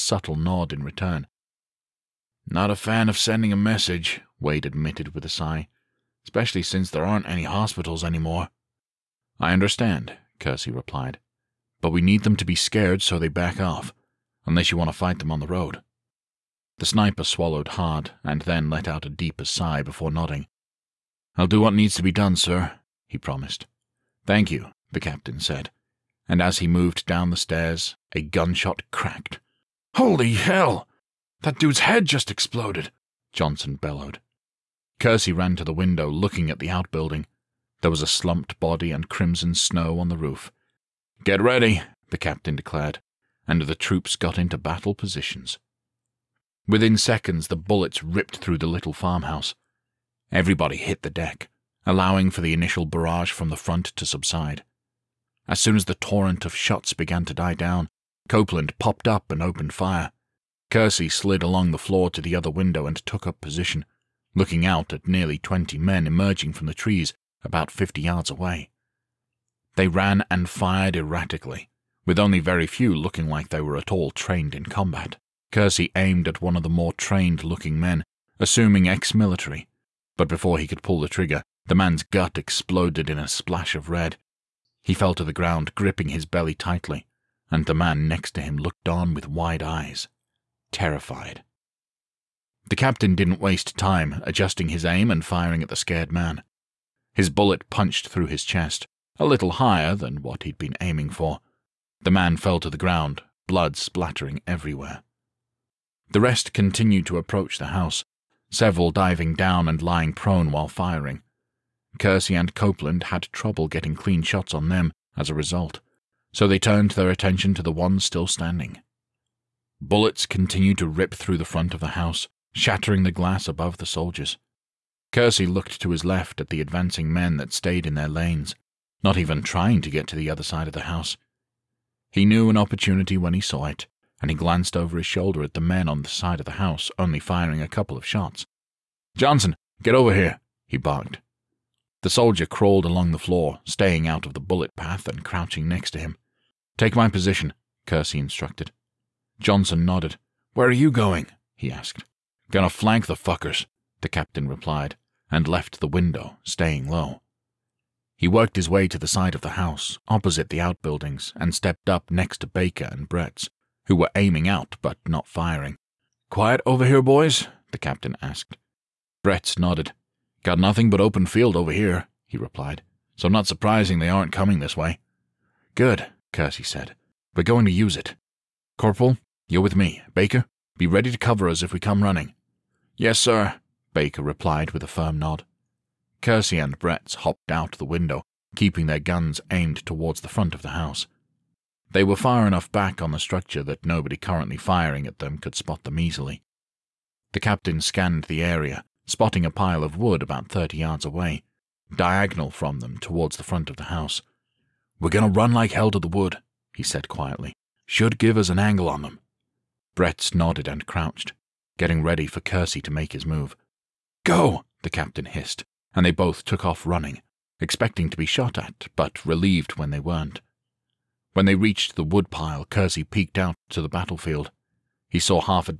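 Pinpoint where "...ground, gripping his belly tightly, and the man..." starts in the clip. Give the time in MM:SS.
01:25.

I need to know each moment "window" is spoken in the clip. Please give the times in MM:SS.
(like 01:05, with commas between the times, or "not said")
00:35, 01:02, 02:35, 03:07.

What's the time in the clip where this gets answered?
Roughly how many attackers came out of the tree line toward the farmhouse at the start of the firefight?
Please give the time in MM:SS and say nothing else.
01:05.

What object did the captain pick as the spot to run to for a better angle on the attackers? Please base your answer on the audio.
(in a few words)
a pile of wood.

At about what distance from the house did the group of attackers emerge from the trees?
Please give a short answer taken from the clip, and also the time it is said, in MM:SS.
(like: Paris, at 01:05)
about 50 yards, at 01:07.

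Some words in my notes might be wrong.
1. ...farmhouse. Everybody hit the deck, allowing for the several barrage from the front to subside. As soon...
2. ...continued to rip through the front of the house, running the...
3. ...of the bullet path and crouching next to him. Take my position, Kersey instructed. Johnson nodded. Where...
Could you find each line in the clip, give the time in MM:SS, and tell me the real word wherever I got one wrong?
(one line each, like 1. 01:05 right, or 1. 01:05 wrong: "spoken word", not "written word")
1. 00:48 wrong: "initial", not "several"
2. 02:00 wrong: "shattering", not "running"
3. 02:24 right.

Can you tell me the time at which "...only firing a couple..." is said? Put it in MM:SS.
02:16.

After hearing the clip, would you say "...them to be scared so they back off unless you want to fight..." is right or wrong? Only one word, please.
right.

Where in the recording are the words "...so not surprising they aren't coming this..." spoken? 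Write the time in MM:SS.
02:53.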